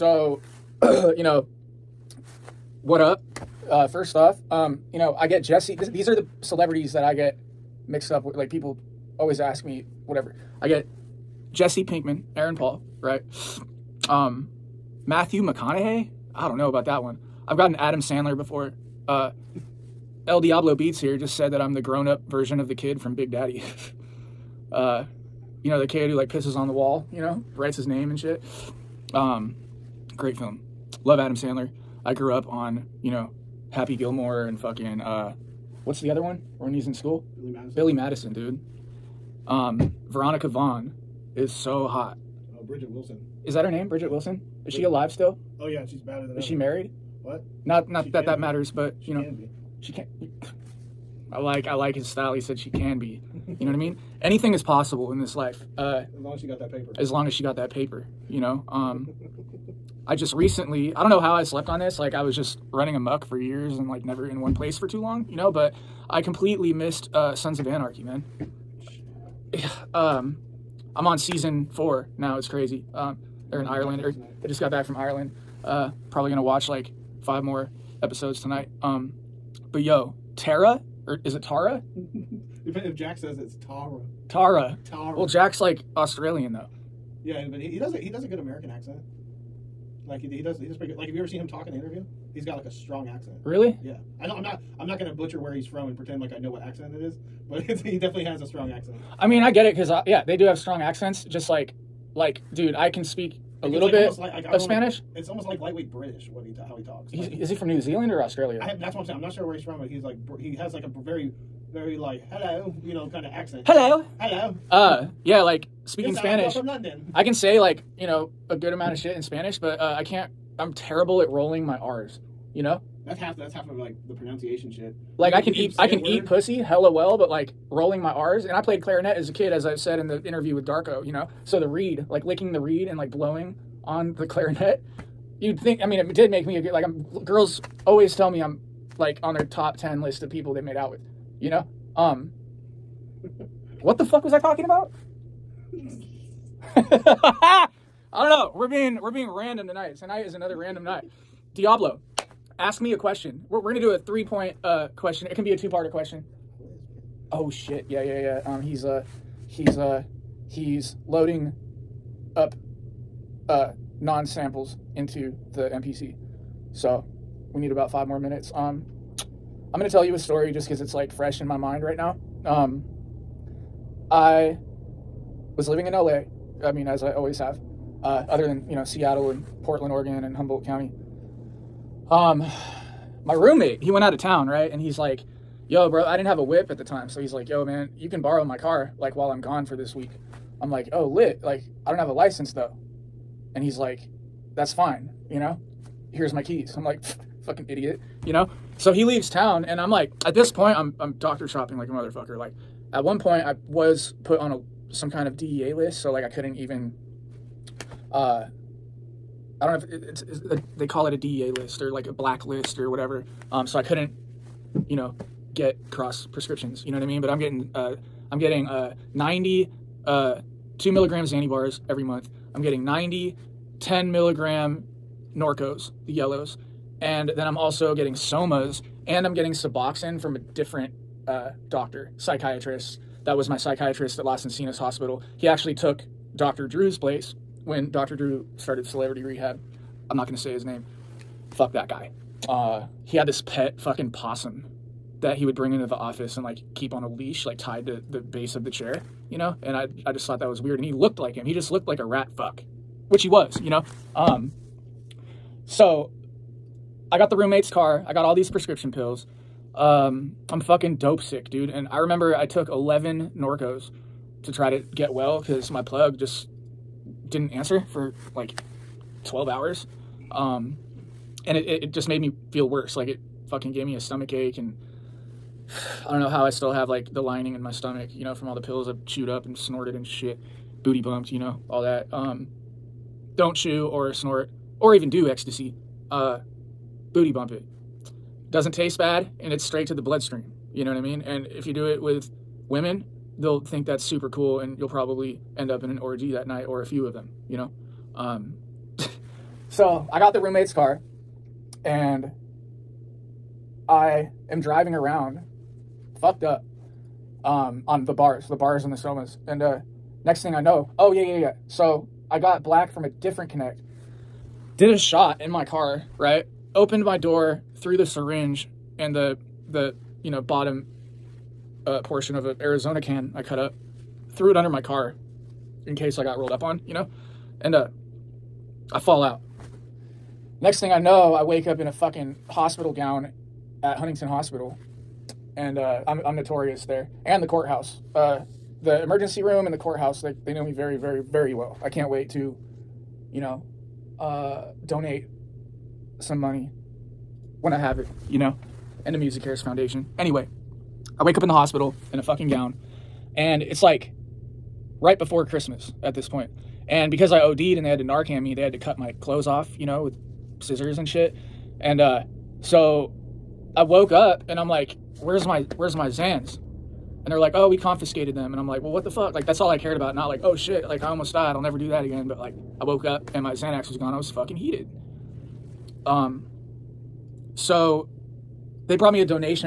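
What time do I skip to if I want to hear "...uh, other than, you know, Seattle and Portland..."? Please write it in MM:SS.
02:58.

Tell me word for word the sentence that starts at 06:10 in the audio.
Not like, "Oh shit!" Like I almost died.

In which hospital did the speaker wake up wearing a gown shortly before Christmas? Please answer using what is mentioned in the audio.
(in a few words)
Huntington Hospital.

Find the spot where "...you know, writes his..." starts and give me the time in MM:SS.
00:27.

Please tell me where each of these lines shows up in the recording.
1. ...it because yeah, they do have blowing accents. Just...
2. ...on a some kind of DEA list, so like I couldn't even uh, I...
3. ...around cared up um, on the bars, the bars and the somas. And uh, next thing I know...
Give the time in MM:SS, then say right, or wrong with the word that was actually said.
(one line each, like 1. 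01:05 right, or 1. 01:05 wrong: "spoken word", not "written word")
1. 01:39 wrong: "strong", not "blowing"
2. 03:24 right
3. 05:04 wrong: "fucked", not "cared".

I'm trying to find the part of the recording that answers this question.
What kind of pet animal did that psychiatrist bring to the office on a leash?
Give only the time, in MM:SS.
04:04.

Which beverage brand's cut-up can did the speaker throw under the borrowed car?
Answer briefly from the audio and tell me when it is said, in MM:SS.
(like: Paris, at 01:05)
Arizona, at 05:22.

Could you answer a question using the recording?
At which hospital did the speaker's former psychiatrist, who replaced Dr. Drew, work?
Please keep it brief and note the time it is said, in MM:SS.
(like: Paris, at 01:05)
Las Encinas Hospital, at 03:54.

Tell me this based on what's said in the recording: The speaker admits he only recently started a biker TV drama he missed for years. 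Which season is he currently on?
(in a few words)
4.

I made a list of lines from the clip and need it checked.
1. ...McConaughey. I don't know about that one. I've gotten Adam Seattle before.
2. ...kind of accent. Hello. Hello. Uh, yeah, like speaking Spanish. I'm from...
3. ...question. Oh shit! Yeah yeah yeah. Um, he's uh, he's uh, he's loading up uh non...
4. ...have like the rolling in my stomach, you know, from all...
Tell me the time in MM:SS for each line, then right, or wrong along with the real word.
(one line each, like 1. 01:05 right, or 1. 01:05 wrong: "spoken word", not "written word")
1. 00:15 wrong: "Sandler", not "Seattle"
2. 01:53 right
3. 02:35 right
4. 04:36 wrong: "lining", not "rolling".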